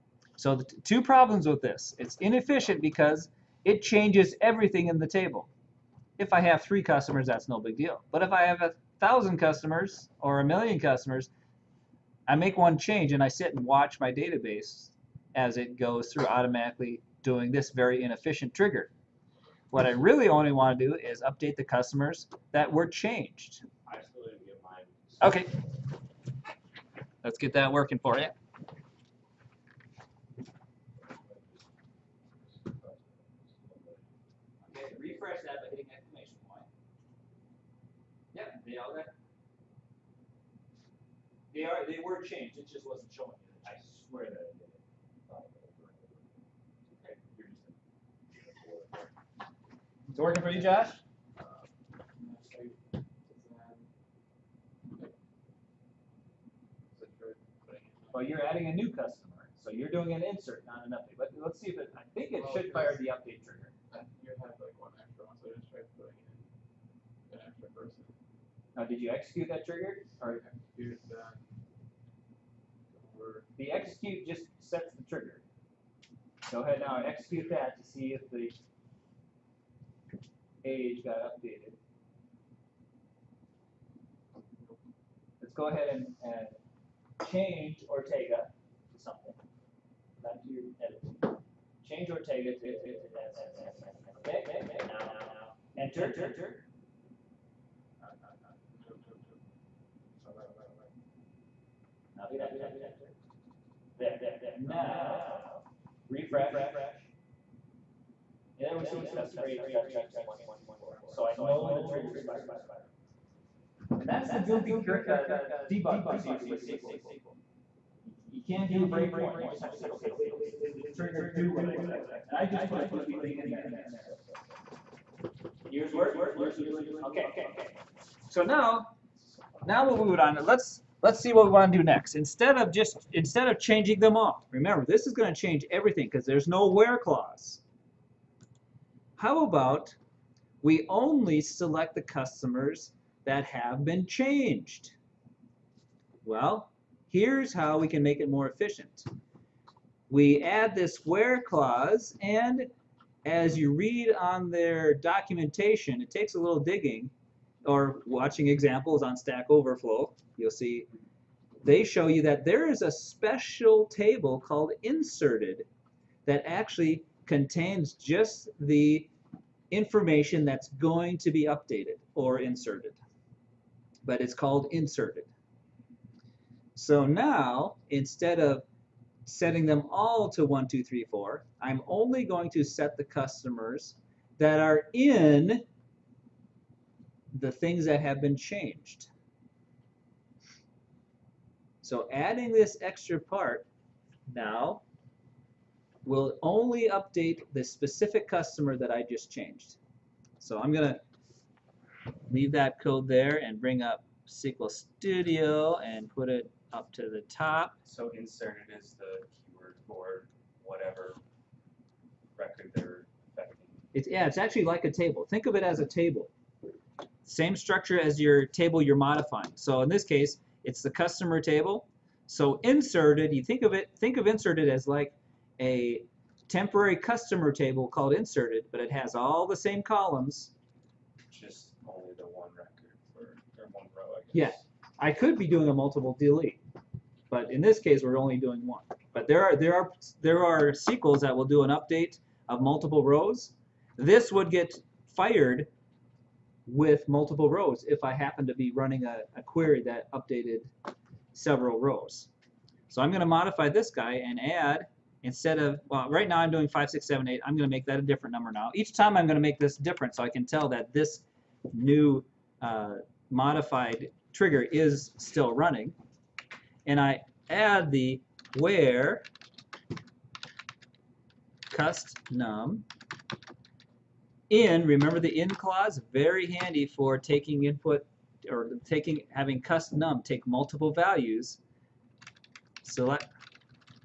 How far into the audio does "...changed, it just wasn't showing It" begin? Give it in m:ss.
0:42.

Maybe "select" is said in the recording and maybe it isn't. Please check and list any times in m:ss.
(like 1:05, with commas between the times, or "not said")
2:21, 4:42.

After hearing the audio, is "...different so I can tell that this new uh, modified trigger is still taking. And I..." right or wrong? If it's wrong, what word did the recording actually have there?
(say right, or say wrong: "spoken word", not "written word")
wrong: "running", not "taking".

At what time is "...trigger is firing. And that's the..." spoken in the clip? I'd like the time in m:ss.
1:51.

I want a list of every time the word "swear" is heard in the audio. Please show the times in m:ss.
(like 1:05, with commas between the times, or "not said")
0:44.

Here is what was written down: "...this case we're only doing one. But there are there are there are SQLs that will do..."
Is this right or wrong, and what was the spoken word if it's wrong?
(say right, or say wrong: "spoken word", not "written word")
right.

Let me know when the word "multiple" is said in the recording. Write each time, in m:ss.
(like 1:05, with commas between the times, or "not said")
3:55, 4:02, 4:07, 4:40.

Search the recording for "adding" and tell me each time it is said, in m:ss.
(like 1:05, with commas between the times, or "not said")
0:58, 3:12.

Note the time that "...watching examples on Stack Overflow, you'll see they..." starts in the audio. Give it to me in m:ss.
2:38.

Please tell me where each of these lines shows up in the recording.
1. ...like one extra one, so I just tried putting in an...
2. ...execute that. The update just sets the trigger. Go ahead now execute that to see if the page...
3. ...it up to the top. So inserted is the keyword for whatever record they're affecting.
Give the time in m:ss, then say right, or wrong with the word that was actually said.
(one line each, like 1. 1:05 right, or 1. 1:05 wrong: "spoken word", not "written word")
1. 1:04 right
2. 1:10 wrong: "execute", not "update"
3. 3:26 right.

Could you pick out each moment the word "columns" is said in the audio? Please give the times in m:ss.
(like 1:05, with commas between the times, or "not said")
3:49.